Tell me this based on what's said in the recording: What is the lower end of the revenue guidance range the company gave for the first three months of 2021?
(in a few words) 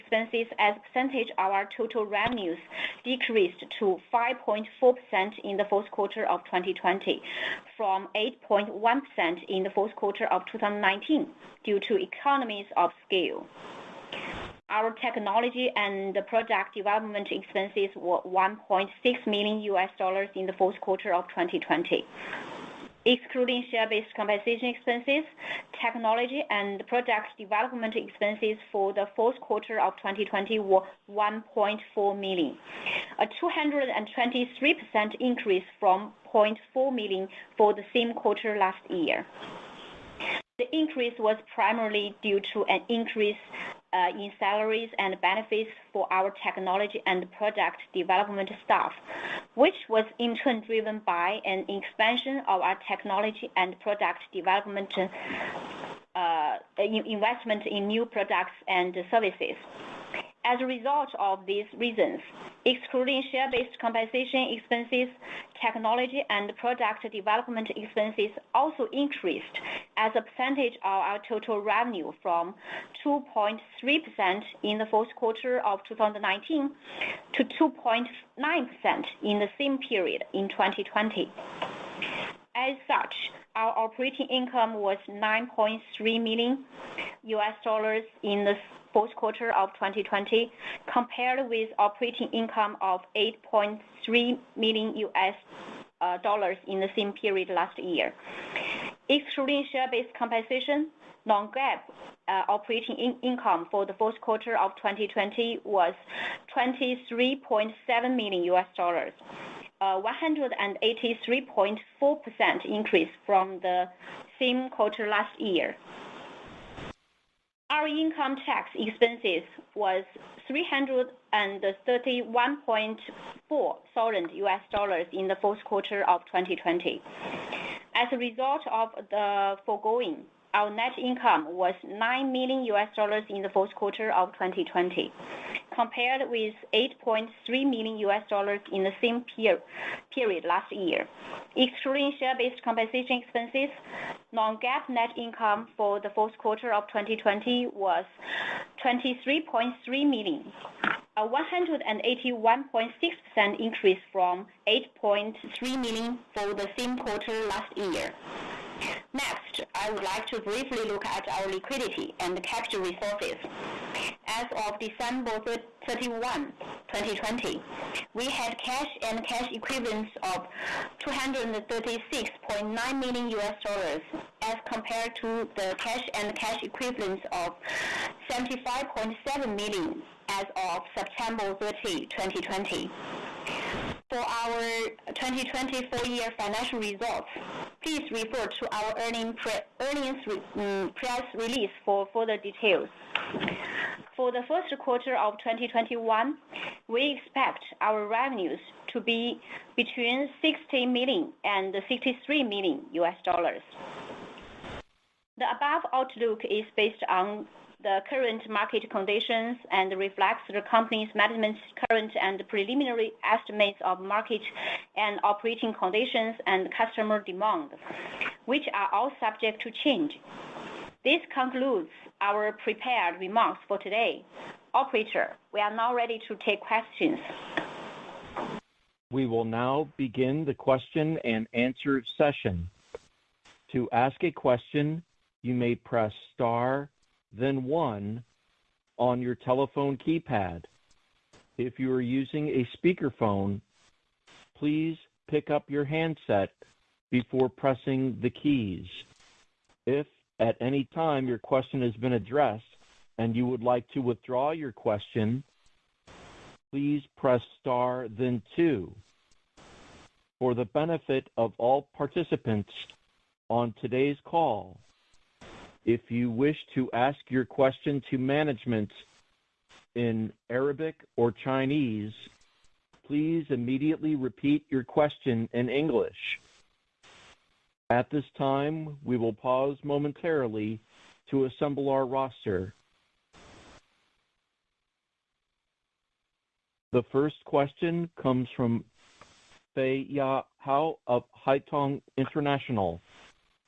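$60 million.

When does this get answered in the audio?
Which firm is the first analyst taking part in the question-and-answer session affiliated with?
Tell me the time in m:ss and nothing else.
4:51.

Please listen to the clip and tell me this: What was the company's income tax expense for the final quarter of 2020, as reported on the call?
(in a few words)
$331.4 thousand.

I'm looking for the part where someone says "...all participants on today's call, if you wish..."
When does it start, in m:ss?
4:21.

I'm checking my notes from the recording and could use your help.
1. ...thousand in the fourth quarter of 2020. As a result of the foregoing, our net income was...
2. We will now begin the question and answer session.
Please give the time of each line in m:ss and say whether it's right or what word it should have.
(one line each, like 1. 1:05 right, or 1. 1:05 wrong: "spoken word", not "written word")
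1. 2:03 right
2. 3:49 right.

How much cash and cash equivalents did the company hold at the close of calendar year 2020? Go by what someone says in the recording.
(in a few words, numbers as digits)
$236.9 million.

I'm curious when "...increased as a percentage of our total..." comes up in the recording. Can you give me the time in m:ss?
1:08.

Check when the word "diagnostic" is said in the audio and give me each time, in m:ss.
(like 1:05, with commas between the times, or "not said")
not said.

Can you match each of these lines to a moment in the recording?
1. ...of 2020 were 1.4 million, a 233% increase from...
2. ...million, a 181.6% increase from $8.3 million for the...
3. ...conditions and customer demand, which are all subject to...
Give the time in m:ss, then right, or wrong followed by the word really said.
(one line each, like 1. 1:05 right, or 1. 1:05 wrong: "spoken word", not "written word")
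1. 0:29 wrong: "223", not "233"
2. 2:30 right
3. 3:35 right.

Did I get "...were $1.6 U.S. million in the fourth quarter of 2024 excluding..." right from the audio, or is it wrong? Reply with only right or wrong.
wrong.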